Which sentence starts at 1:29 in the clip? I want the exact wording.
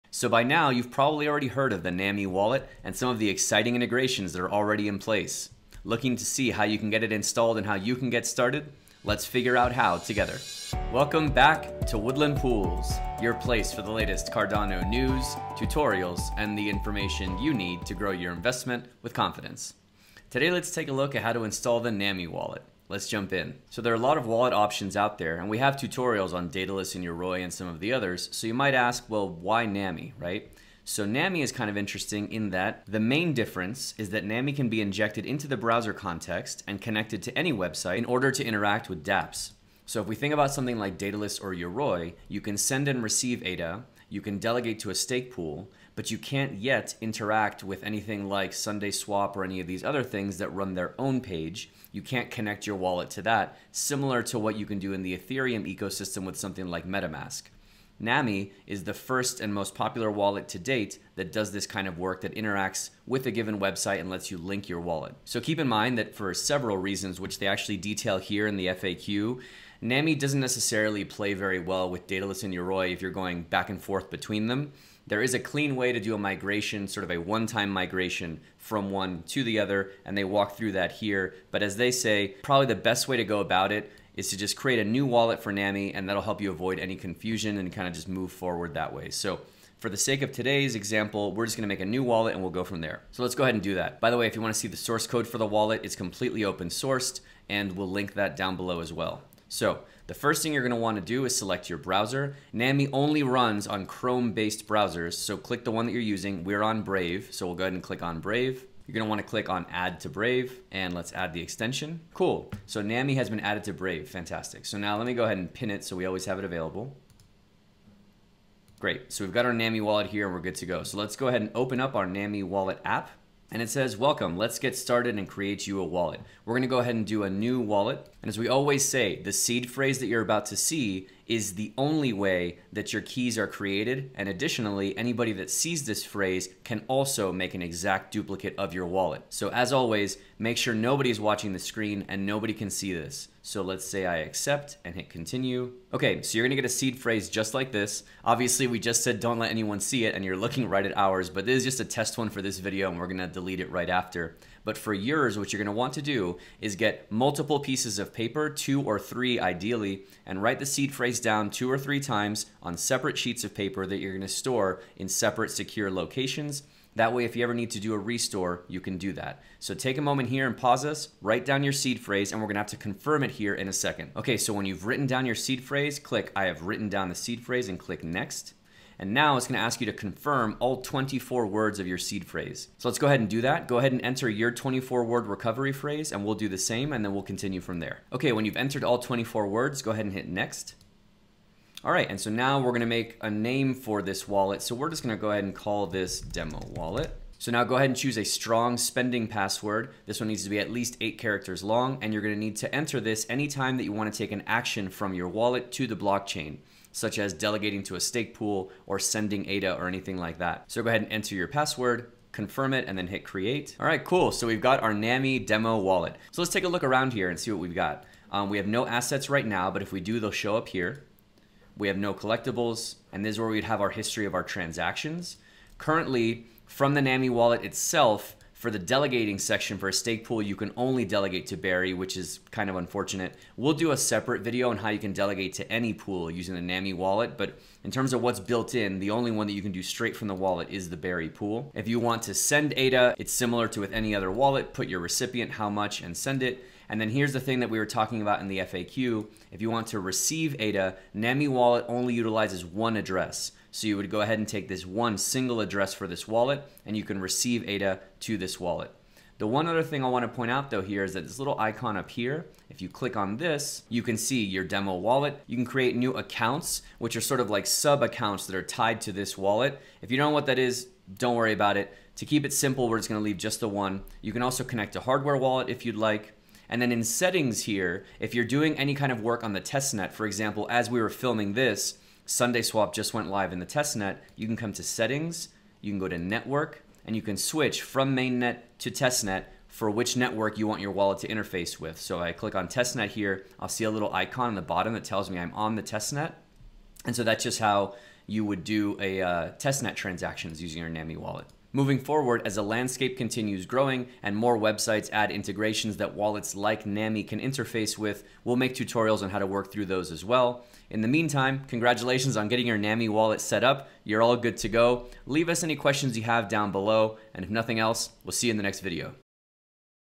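So for the sake of today's example, we're just gonna make a new wallet and we'll go from there.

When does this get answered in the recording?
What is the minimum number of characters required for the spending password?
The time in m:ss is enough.
3:21.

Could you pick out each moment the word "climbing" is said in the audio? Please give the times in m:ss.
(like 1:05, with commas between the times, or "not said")
not said.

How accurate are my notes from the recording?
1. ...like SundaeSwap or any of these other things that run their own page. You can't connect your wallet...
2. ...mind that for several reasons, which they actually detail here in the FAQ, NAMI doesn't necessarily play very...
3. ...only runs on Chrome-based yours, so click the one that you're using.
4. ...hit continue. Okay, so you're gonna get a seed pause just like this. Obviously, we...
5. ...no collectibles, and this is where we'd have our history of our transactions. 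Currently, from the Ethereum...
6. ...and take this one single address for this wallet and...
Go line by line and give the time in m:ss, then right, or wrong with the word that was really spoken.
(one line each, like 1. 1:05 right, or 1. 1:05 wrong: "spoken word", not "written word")
1. 0:48 right
2. 1:05 right
3. 1:42 wrong: "browsers", not "yours"
4. 2:24 wrong: "phrase", not "pause"
5. 3:41 wrong: "NAMI", not "Ethereum"
6. 4:14 right.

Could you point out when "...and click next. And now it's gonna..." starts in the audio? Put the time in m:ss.
2:57.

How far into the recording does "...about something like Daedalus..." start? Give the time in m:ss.
0:40.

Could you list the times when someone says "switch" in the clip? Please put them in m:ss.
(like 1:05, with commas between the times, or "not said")
4:47.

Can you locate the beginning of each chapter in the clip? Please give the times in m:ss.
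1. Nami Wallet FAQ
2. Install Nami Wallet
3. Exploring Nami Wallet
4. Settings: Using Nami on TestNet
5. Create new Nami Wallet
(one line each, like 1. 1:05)
1. 0:23
2. 1:39
3. 3:33
4. 4:36
5. 2:00.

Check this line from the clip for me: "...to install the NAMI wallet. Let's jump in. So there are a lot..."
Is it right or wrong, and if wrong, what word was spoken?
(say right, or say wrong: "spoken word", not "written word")
right.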